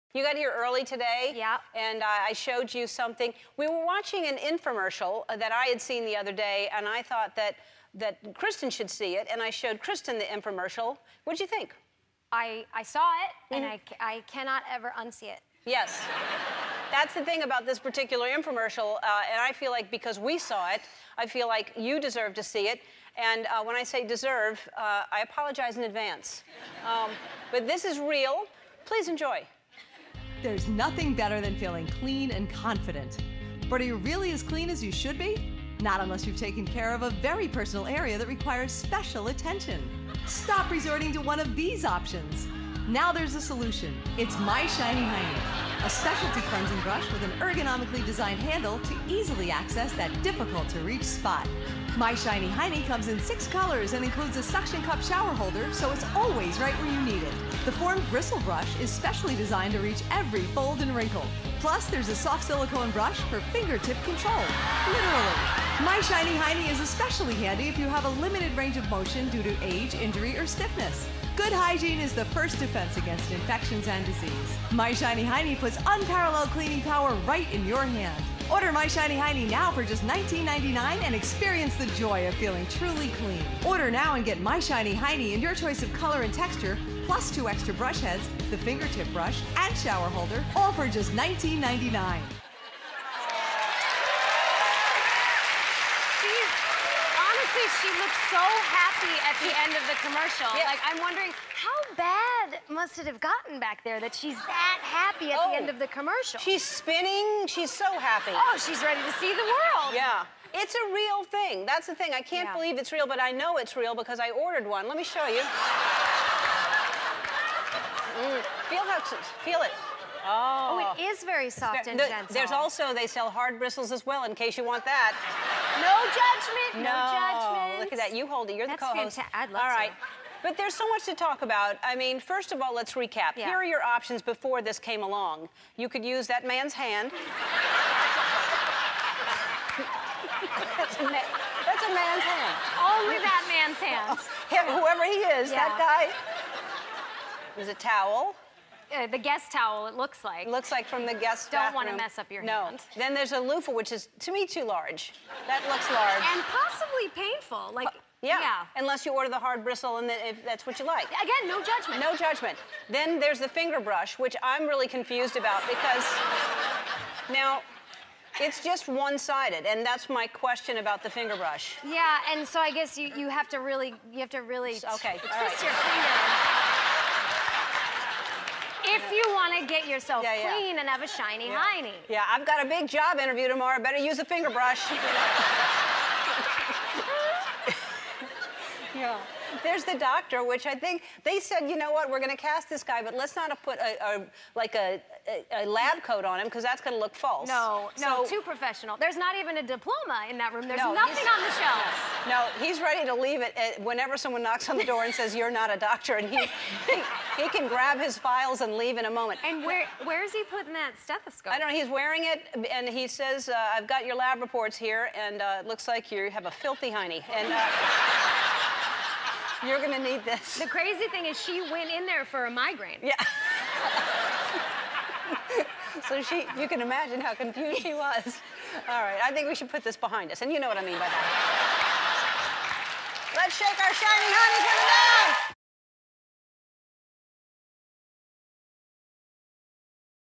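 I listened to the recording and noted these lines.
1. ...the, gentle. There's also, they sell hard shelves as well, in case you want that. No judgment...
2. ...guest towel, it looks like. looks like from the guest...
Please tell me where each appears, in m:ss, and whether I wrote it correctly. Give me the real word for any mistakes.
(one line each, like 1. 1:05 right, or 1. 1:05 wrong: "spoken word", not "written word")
1. 2:01 wrong: "bristles", not "shelves"
2. 2:29 right.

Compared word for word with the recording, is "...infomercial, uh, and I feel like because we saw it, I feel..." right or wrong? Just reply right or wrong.
right.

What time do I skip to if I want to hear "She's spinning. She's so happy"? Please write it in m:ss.
1:46.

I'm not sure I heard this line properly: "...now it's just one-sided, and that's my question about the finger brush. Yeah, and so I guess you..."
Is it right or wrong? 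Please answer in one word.
right.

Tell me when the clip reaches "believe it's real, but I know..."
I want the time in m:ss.
1:52.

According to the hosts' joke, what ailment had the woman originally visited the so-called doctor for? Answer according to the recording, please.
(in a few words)
a migraine.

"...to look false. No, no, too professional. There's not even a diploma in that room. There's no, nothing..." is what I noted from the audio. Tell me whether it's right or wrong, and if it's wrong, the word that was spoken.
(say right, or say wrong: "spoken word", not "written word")
right.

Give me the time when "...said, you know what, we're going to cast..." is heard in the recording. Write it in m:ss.
3:11.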